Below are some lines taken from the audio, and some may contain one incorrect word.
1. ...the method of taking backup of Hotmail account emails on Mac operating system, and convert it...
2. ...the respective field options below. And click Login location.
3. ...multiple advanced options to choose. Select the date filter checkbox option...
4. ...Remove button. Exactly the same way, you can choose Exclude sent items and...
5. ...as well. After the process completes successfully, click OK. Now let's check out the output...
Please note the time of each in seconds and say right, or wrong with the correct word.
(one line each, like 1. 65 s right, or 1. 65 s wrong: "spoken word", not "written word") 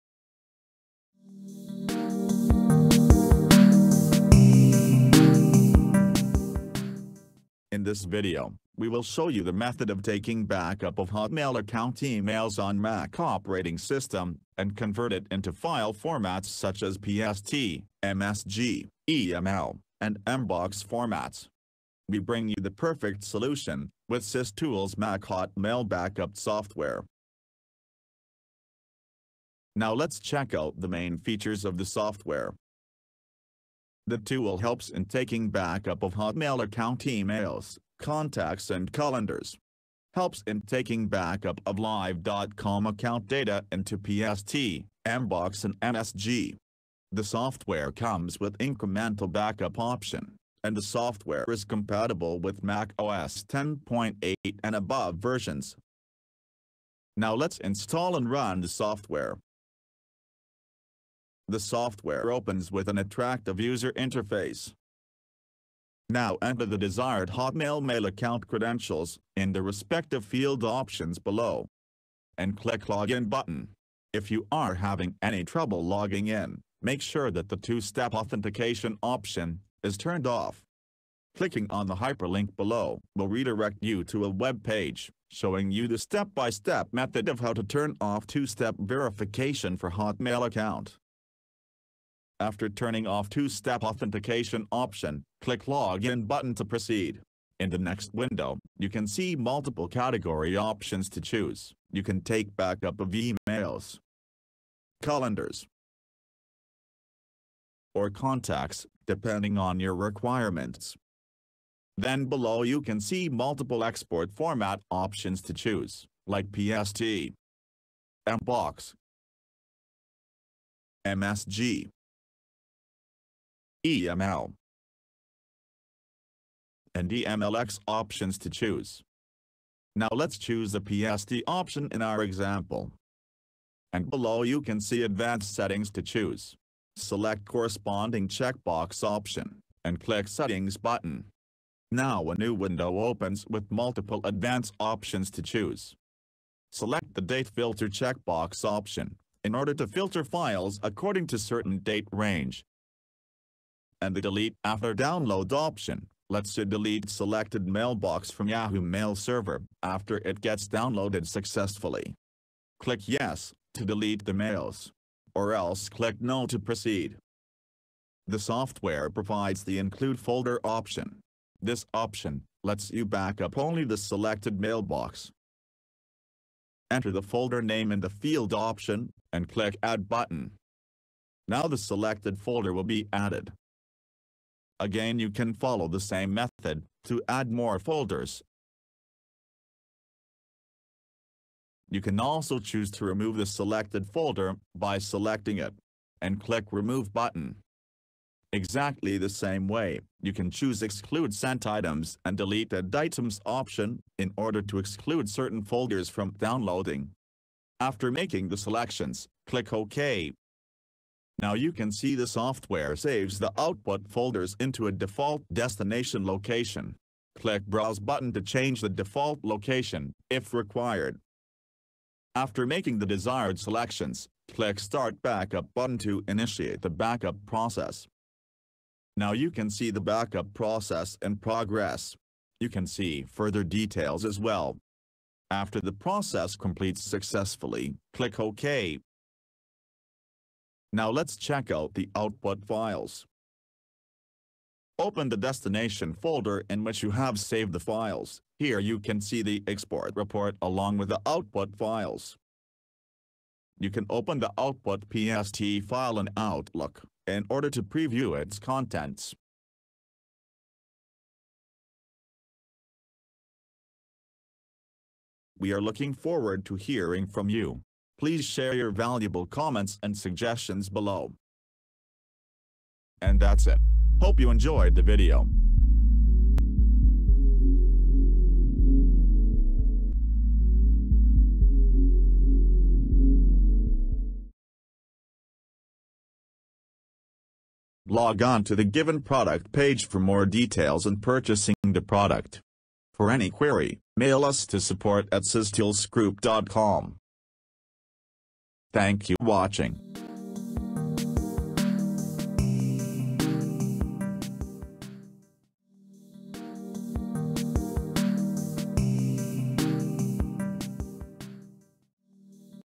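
1. 9 s right
2. 69 s wrong: "button", not "location"
3. 143 s right
4. 196 s right
5. 234 s right.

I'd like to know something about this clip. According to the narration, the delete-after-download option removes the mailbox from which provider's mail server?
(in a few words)
Yahoo Mail.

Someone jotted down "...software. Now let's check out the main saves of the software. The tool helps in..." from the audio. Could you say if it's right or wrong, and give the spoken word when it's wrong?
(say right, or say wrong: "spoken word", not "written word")
wrong: "features", not "saves".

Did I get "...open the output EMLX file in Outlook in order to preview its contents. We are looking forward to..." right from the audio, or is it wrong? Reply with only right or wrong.
wrong.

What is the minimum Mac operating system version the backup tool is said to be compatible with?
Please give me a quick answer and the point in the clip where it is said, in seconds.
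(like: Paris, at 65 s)
Mac OS 10.8, at 52 s.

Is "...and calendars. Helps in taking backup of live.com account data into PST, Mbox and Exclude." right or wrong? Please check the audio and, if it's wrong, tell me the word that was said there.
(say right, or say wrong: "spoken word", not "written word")
wrong: "MSG", not "Exclude".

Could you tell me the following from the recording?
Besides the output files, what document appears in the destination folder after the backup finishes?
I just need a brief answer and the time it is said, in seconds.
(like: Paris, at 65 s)
export report, at 249 s.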